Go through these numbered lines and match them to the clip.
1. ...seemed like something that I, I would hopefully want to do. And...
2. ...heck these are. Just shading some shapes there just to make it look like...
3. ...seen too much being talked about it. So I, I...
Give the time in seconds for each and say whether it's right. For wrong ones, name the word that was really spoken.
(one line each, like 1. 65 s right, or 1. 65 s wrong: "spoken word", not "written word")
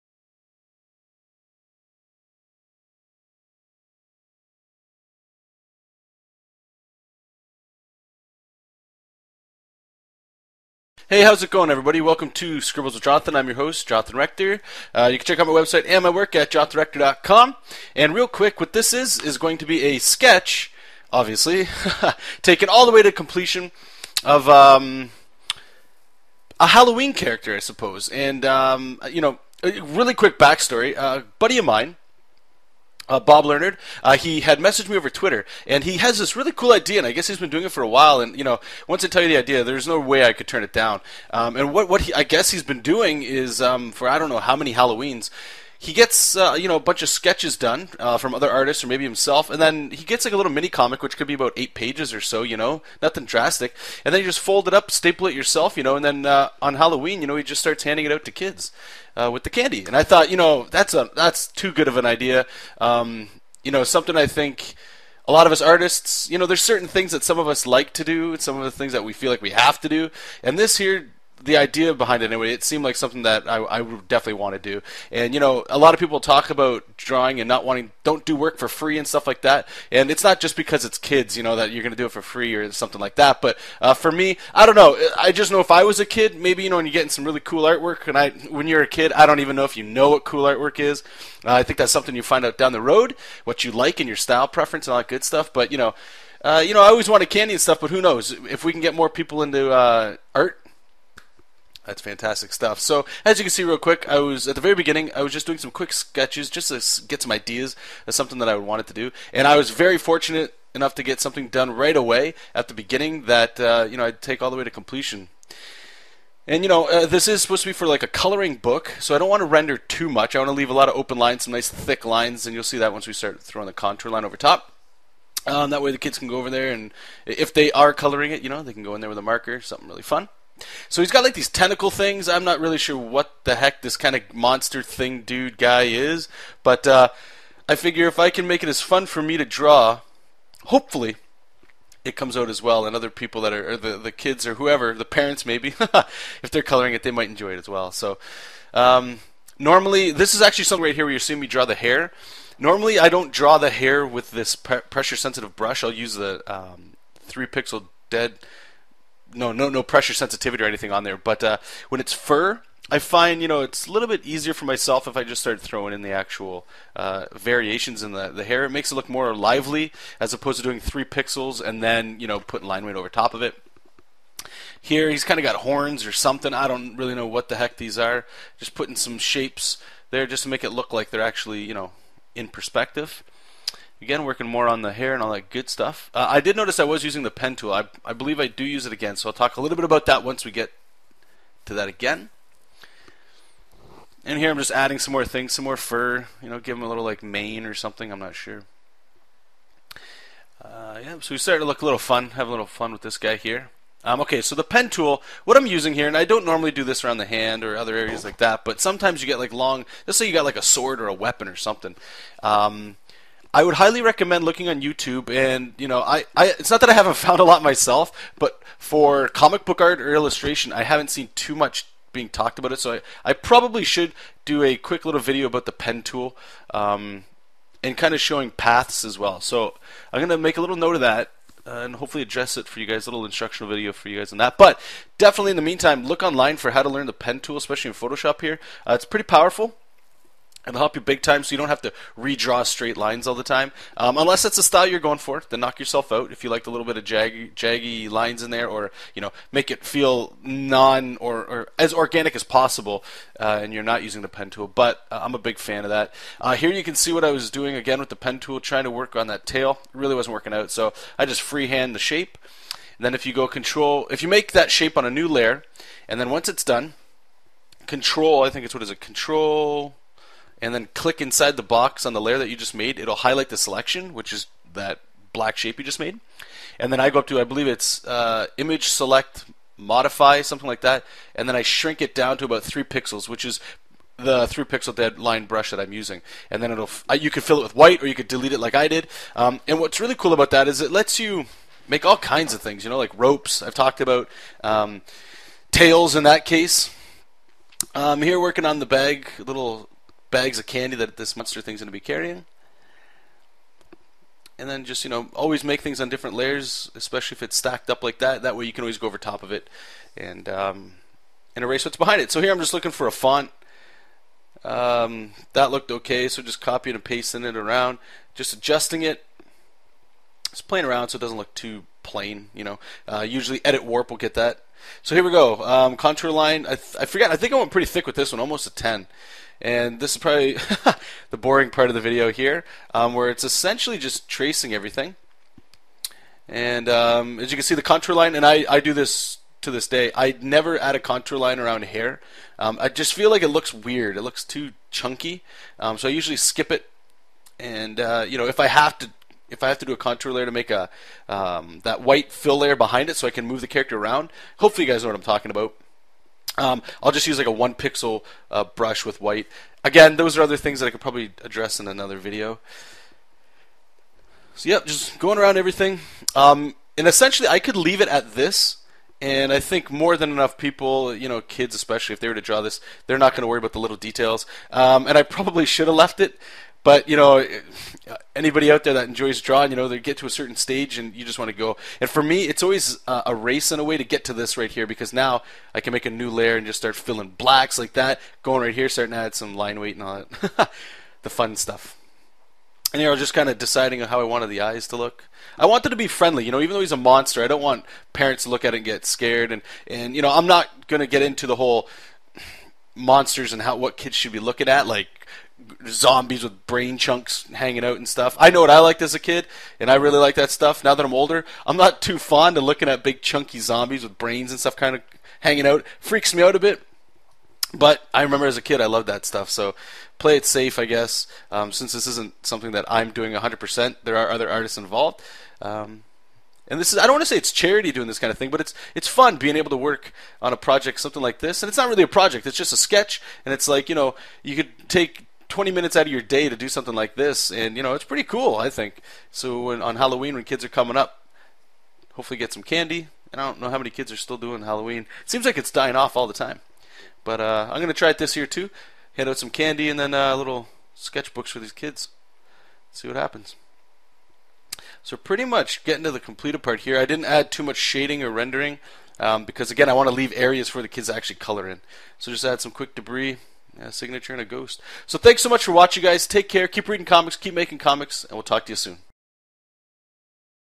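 1. 72 s wrong: "definitely", not "hopefully"
2. 177 s wrong: "putting", not "shading"
3. 221 s right.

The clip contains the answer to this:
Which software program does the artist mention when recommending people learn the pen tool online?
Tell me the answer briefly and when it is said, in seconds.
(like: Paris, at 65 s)
Photoshop, at 237 s.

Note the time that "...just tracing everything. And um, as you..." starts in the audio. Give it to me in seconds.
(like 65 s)
333 s.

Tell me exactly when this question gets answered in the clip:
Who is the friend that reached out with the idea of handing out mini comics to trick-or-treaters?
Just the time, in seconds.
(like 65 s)
33 s.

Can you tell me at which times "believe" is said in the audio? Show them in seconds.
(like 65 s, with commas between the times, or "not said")
188 s, 277 s.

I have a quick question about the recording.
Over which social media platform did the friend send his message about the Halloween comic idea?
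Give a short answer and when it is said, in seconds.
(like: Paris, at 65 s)
Twitter, at 35 s.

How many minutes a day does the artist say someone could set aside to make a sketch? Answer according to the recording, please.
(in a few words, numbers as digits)
20.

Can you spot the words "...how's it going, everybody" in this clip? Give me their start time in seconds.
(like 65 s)
11 s.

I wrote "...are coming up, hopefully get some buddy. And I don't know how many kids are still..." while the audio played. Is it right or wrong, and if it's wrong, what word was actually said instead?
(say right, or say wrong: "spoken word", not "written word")
wrong: "candy", not "buddy".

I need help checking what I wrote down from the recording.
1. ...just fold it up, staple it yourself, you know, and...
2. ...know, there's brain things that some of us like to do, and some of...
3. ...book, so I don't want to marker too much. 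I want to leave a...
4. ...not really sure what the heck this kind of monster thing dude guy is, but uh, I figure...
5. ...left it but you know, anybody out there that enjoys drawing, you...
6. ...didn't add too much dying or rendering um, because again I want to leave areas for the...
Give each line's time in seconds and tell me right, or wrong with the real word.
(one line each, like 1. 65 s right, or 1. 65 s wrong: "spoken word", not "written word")
1. 54 s right
2. 66 s wrong: "certain", not "brain"
3. 118 s wrong: "render", not "marker"
4. 132 s right
5. 375 s right
6. 457 s wrong: "shading", not "dying".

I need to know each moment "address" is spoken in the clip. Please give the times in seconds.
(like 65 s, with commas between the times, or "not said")
232 s, 361 s.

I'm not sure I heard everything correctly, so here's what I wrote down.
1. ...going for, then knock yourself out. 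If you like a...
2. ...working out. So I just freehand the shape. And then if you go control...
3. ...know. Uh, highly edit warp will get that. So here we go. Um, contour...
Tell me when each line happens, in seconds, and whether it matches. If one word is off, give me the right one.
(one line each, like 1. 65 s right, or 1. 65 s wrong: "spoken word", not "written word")
1. 244 s right
2. 260 s right
3. 322 s wrong: "usually", not "highly".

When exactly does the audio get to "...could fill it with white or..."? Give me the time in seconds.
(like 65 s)
287 s.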